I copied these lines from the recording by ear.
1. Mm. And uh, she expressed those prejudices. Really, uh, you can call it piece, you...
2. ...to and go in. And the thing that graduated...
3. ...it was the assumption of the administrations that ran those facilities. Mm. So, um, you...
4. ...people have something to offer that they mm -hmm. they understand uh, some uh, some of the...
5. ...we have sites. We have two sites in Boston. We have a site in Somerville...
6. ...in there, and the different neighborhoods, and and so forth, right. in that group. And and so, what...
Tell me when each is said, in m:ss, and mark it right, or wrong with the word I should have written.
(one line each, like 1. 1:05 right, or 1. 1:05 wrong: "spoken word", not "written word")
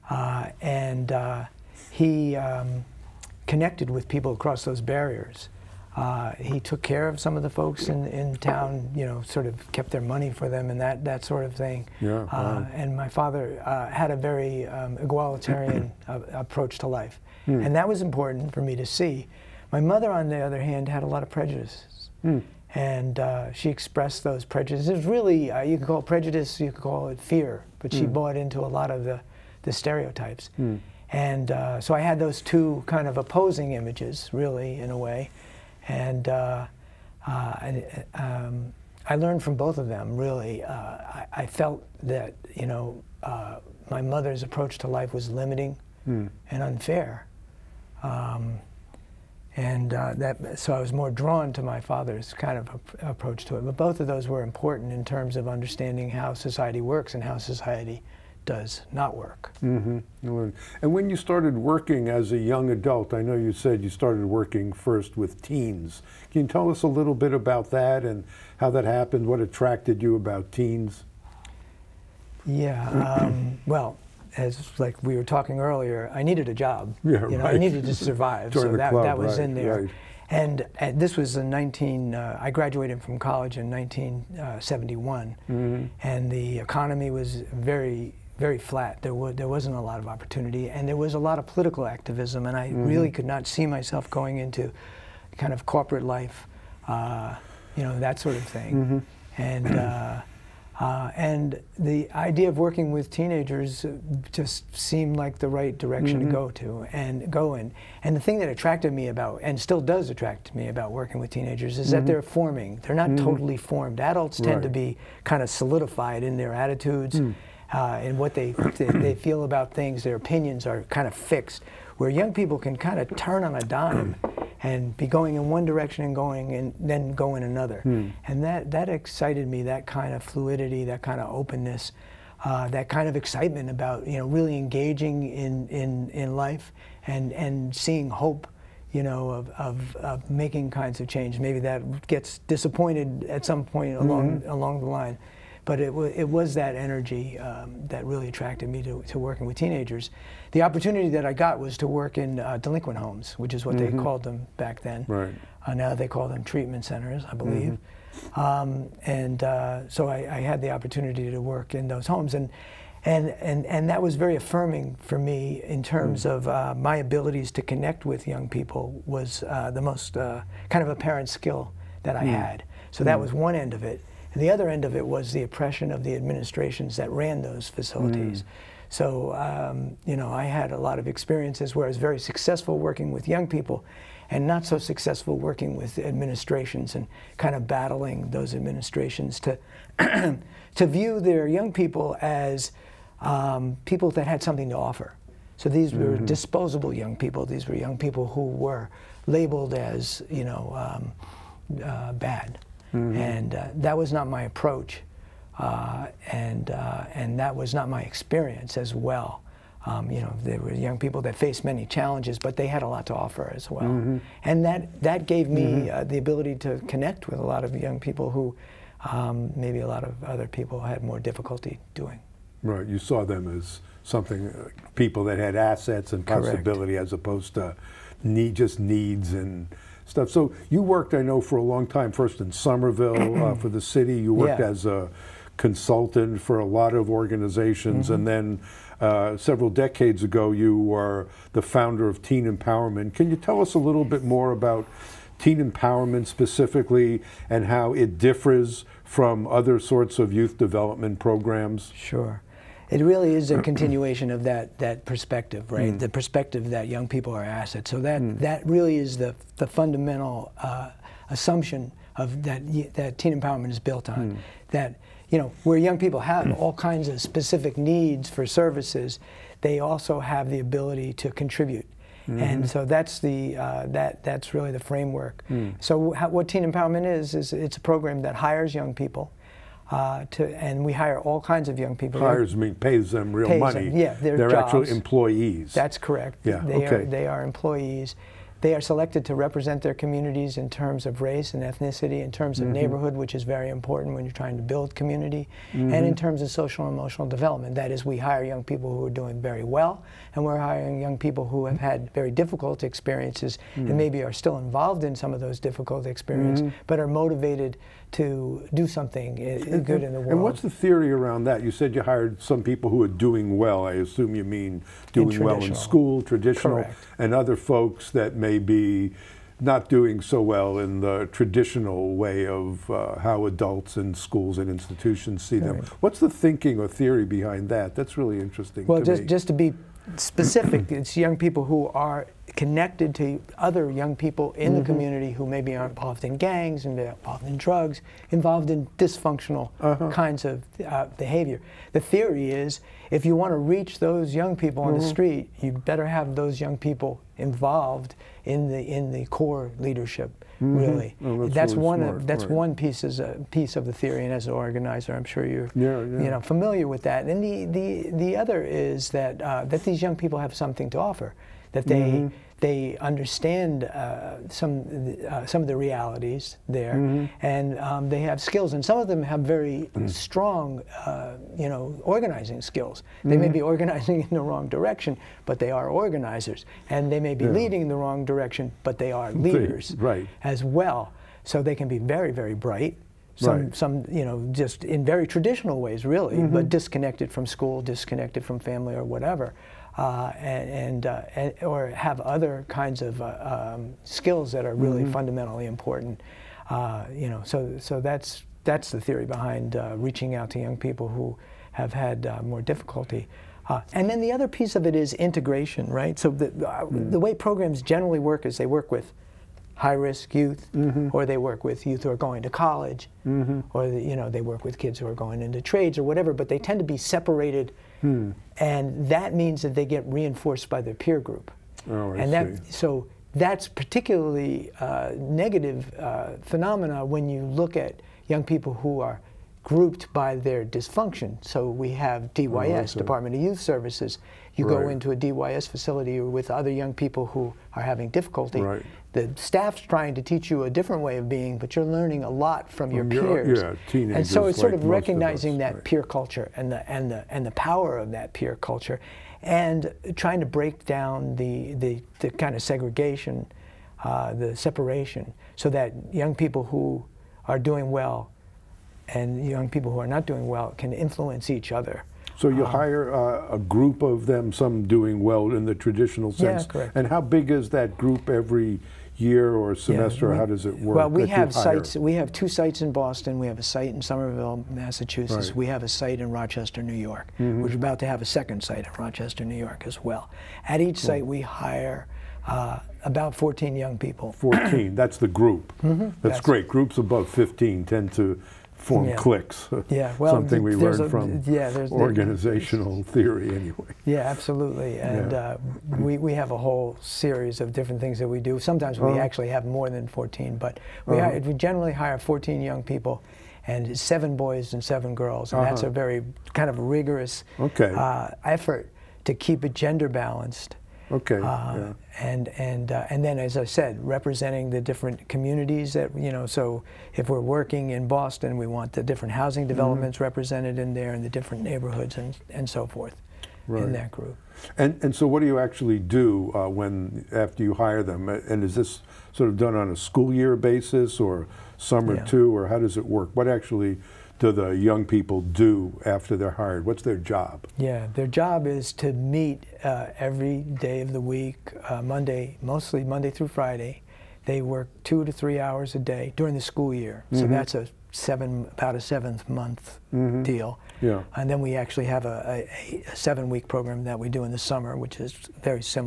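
1. 0:22 wrong: "prejudice", not "piece"
2. 1:46 wrong: "attracted", not "graduated"
3. 2:54 wrong: "oppression", not "assumption"
4. 6:00 right
5. 7:51 right
6. 8:40 right.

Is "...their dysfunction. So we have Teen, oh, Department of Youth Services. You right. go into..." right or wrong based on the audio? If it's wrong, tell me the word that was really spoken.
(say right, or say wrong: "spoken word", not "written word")
wrong: "DYS", not "Teen".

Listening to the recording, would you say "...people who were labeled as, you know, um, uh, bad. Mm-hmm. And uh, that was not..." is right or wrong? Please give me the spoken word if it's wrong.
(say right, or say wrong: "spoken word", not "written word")
right.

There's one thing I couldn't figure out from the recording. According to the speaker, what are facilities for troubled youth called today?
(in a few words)
treatment centers.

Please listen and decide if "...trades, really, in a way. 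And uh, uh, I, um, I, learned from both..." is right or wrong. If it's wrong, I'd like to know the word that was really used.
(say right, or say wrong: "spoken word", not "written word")
wrong: "images", not "trades".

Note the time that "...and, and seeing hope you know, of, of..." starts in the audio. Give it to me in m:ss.
2:17.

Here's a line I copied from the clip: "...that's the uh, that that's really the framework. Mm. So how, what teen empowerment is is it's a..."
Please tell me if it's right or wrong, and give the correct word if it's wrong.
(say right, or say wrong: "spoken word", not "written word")
right.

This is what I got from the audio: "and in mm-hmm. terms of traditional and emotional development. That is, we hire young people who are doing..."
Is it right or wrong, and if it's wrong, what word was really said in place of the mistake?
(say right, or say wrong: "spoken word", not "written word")
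wrong: "social", not "traditional".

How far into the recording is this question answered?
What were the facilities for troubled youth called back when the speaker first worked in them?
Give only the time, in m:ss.
2:32.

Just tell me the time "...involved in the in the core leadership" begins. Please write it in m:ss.
5:47.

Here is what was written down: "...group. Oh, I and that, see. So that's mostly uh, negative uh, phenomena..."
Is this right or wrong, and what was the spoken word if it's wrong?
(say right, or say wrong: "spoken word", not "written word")
wrong: "particularly", not "mostly".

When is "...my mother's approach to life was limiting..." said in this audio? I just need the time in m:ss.
0:43.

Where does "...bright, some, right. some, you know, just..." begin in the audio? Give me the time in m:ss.
6:22.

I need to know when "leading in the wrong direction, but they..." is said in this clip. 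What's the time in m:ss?
6:17.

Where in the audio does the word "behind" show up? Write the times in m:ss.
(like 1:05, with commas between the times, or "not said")
5:27, 6:39.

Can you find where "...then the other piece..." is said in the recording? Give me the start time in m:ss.
6:44.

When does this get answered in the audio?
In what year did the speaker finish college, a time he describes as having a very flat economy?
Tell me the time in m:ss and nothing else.
1:23.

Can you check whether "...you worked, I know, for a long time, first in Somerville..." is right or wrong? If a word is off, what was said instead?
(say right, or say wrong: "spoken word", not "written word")
right.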